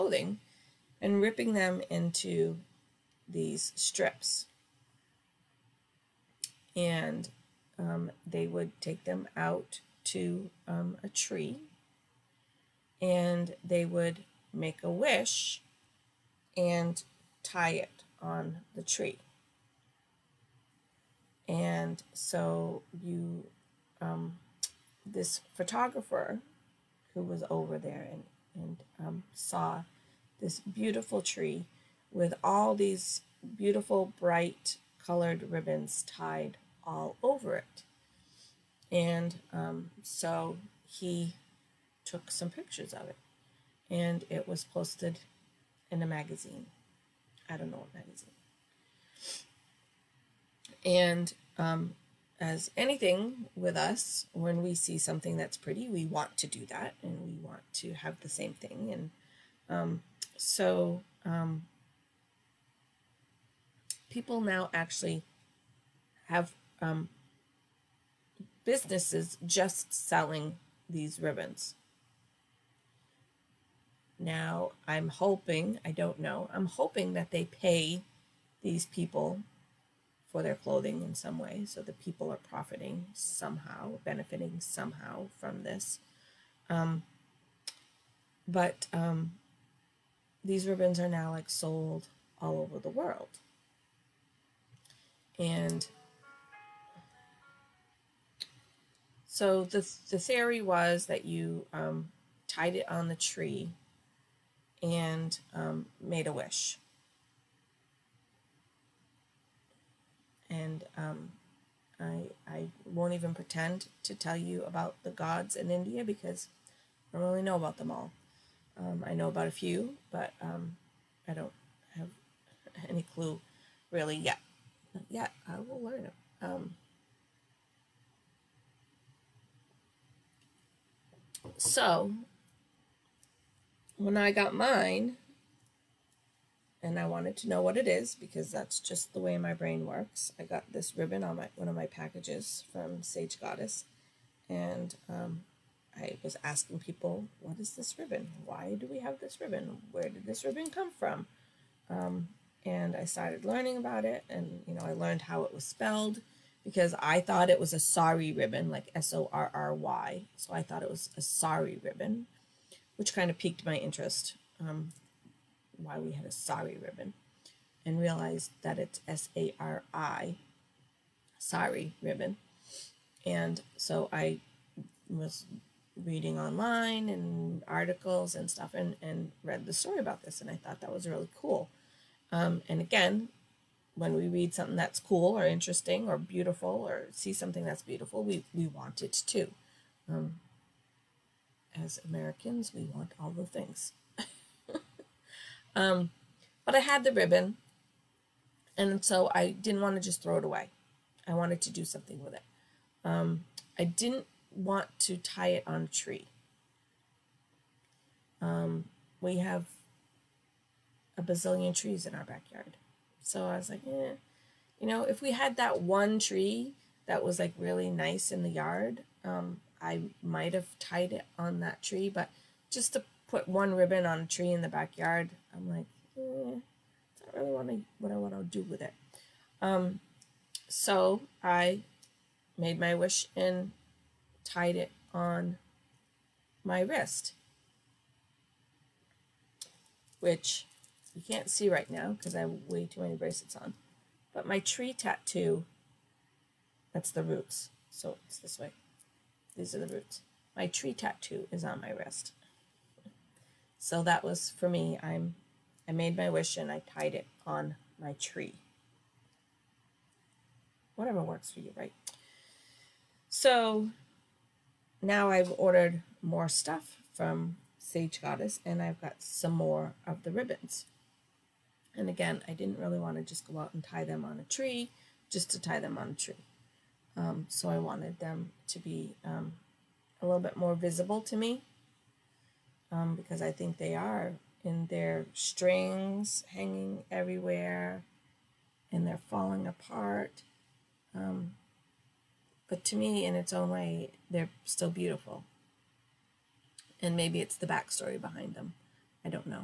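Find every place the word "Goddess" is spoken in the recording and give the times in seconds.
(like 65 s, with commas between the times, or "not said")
143 s, 268 s.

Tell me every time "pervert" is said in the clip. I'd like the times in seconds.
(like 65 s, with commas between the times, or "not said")
not said.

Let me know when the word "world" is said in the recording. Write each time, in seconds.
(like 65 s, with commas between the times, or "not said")
92 s.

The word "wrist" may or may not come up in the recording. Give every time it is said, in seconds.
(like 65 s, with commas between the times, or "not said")
236 s, 251 s.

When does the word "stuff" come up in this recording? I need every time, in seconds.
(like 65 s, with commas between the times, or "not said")
178 s, 266 s.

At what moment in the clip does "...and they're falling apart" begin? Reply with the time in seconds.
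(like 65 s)
288 s.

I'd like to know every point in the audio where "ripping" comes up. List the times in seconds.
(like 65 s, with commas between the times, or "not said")
1 s.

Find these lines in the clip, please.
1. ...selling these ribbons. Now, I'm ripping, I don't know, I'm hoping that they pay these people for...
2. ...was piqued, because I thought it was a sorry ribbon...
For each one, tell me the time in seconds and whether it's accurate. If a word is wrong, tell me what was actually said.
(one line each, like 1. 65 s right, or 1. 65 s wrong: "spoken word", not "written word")
1. 69 s wrong: "hoping", not "ripping"
2. 155 s wrong: "spelled", not "piqued".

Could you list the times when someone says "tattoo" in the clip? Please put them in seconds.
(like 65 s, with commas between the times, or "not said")
244 s, 250 s.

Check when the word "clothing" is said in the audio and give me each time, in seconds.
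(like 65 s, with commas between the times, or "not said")
80 s.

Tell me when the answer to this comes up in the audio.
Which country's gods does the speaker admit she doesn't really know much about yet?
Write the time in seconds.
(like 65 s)
115 s.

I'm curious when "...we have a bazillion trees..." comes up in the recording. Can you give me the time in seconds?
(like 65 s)
209 s.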